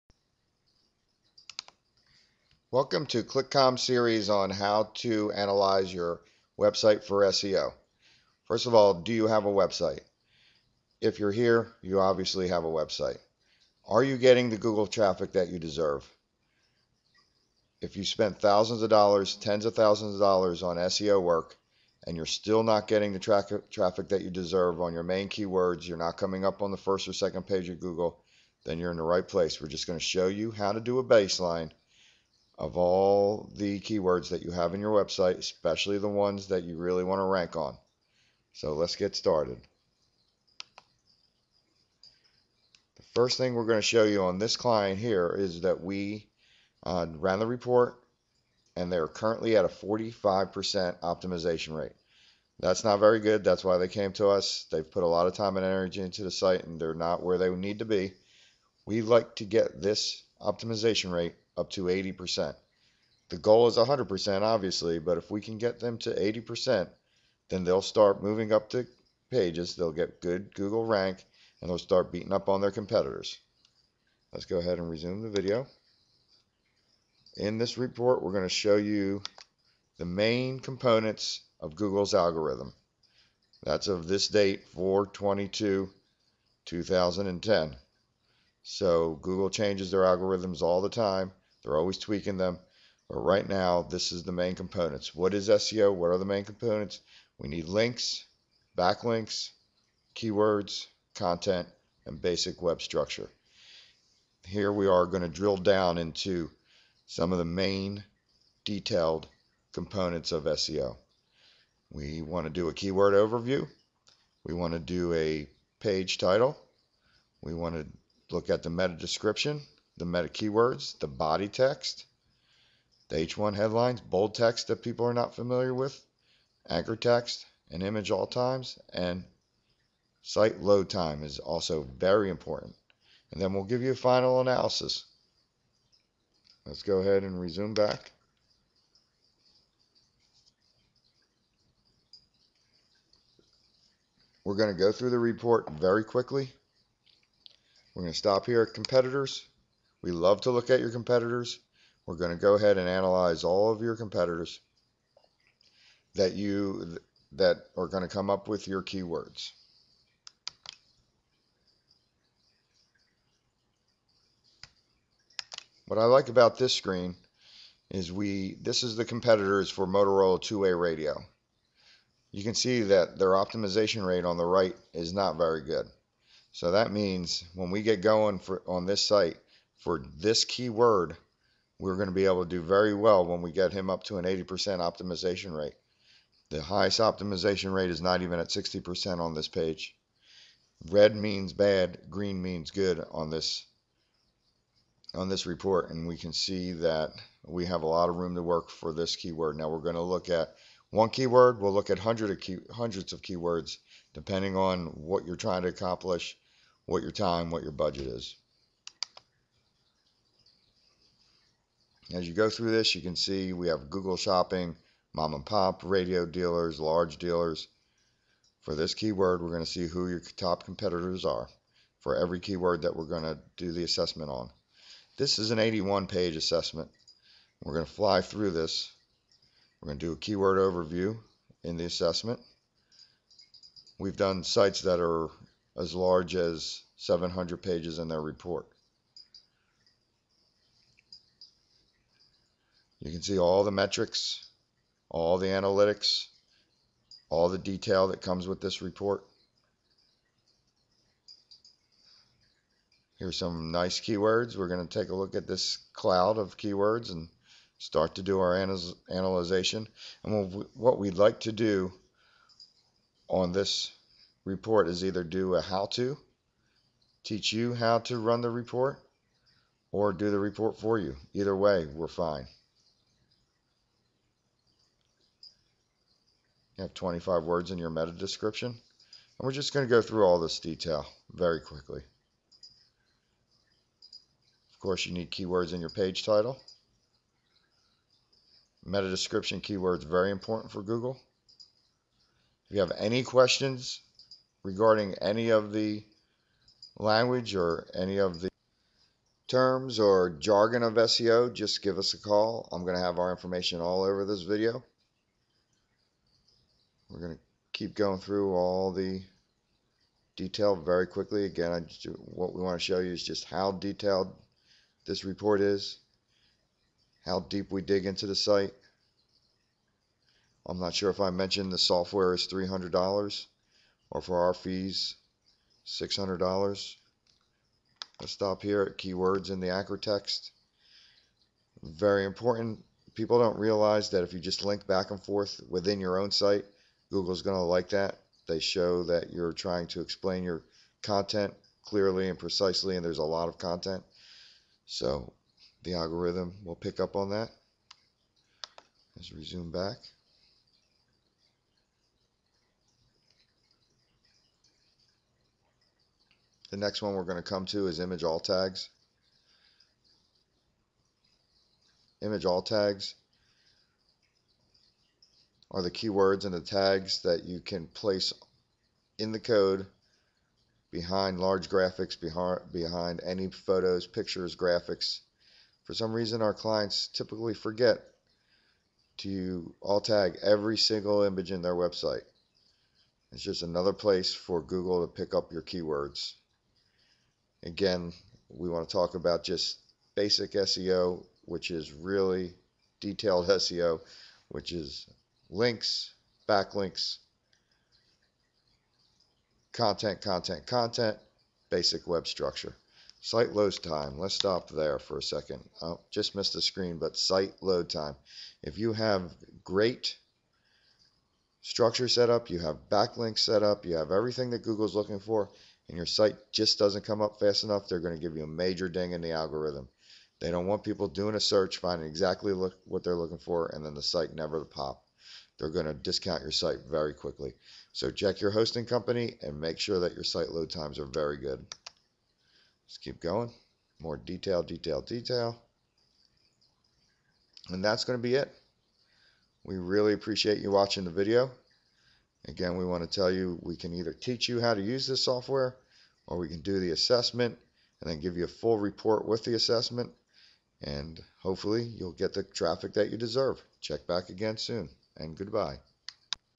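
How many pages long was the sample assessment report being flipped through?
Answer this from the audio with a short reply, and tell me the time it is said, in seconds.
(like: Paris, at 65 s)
81, at 225 s.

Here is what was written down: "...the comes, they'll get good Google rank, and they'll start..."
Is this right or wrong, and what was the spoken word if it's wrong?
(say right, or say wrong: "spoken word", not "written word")
wrong: "pages", not "comes".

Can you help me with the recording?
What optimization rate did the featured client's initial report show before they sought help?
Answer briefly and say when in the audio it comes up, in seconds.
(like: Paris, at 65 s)
45%, at 49 s.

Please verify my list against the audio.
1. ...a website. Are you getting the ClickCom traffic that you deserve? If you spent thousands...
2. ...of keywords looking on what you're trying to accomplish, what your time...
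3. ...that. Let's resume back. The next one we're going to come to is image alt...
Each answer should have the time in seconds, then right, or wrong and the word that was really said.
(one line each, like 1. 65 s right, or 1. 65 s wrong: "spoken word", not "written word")
1. 12 s wrong: "Google", not "ClickCom"
2. 203 s wrong: "depending", not "looking"
3. 347 s right.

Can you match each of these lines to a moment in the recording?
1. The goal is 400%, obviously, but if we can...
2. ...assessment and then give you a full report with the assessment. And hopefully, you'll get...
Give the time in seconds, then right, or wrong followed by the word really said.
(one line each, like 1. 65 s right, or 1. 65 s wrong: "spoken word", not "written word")
1. 63 s wrong: "100", not "400"
2. 446 s right.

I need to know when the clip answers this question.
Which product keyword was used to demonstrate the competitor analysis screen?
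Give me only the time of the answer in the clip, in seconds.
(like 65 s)
169 s.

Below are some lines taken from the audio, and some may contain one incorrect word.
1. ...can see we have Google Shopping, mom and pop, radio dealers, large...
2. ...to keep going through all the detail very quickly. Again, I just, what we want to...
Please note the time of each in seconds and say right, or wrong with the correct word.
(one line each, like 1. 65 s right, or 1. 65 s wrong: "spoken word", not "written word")
1. 213 s right
2. 307 s right.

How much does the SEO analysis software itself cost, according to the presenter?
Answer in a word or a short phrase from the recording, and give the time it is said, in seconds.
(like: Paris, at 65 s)
$300, at 322 s.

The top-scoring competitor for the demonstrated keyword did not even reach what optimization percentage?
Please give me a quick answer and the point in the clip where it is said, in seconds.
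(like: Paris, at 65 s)
60%, at 188 s.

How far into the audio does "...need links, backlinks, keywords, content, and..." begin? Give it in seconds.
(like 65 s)
97 s.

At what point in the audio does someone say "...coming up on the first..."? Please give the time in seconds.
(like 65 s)
26 s.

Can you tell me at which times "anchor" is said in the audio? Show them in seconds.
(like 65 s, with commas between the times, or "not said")
126 s, 329 s.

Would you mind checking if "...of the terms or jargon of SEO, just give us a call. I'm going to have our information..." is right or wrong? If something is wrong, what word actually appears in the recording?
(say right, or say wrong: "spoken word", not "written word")
right.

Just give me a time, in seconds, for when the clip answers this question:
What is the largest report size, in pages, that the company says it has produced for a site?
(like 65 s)
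236 s.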